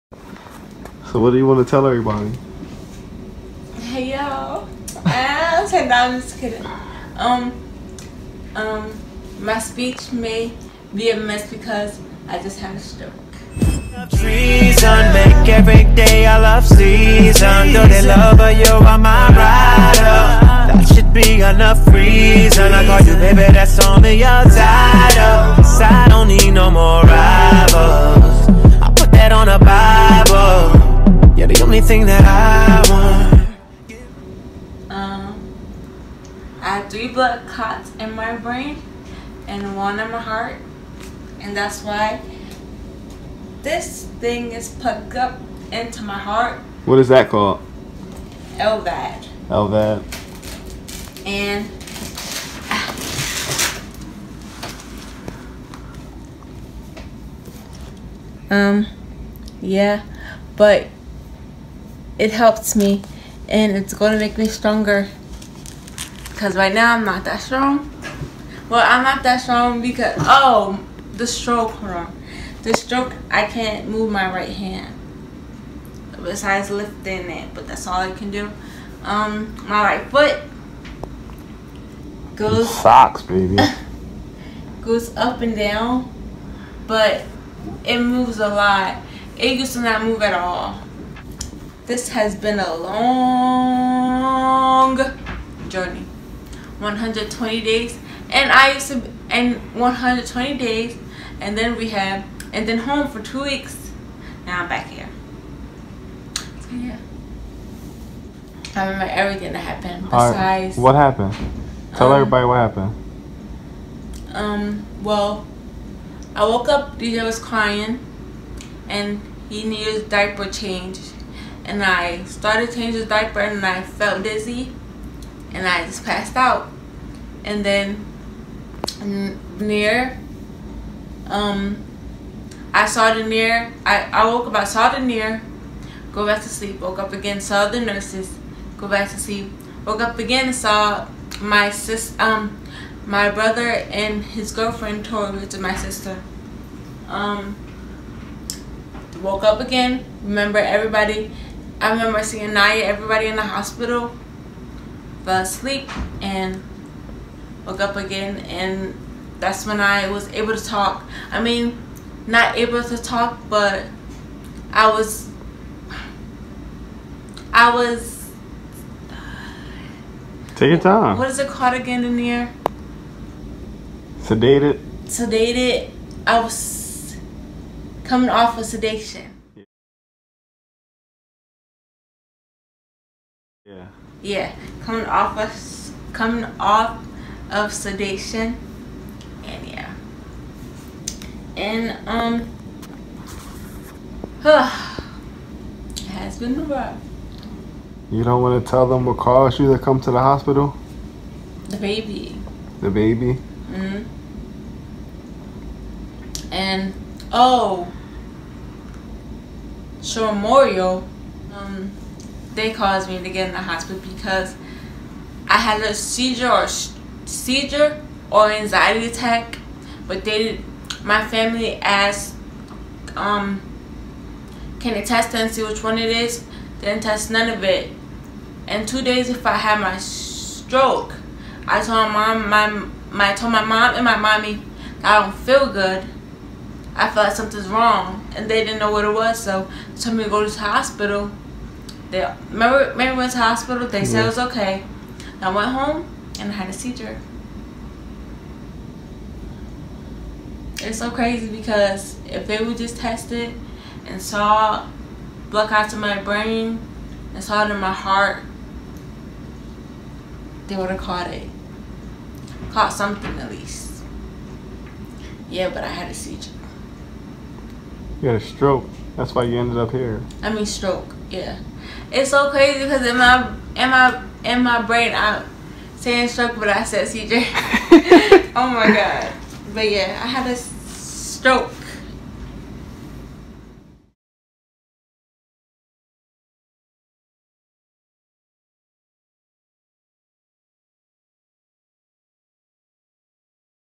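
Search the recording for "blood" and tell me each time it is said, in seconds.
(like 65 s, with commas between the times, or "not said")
37 s, 255 s.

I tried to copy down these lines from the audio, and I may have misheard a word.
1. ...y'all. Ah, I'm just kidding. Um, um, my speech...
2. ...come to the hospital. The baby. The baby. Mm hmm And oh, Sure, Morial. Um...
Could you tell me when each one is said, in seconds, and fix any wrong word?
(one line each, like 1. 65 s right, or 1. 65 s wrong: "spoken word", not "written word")
1. 4 s right
2. 199 s right.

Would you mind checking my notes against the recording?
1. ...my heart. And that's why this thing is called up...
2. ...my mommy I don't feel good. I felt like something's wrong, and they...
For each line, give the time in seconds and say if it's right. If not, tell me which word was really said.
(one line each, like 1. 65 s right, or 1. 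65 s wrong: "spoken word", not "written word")
1. 40 s wrong: "plugged", not "called"
2. 234 s right.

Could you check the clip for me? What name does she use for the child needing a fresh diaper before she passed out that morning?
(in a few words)
DJ.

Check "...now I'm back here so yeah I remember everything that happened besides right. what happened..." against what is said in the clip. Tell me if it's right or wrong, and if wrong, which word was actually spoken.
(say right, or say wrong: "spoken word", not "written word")
right.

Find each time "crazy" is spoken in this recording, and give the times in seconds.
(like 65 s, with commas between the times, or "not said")
251 s, 272 s.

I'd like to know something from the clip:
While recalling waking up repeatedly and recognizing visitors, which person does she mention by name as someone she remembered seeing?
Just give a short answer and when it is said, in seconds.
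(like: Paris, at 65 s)
Naya, at 152 s.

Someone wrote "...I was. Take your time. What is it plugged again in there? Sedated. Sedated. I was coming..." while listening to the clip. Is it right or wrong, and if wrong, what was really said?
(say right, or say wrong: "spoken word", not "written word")
wrong: "called", not "plugged".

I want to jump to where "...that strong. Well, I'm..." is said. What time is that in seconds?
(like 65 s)
67 s.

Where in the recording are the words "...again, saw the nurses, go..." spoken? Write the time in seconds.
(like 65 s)
137 s.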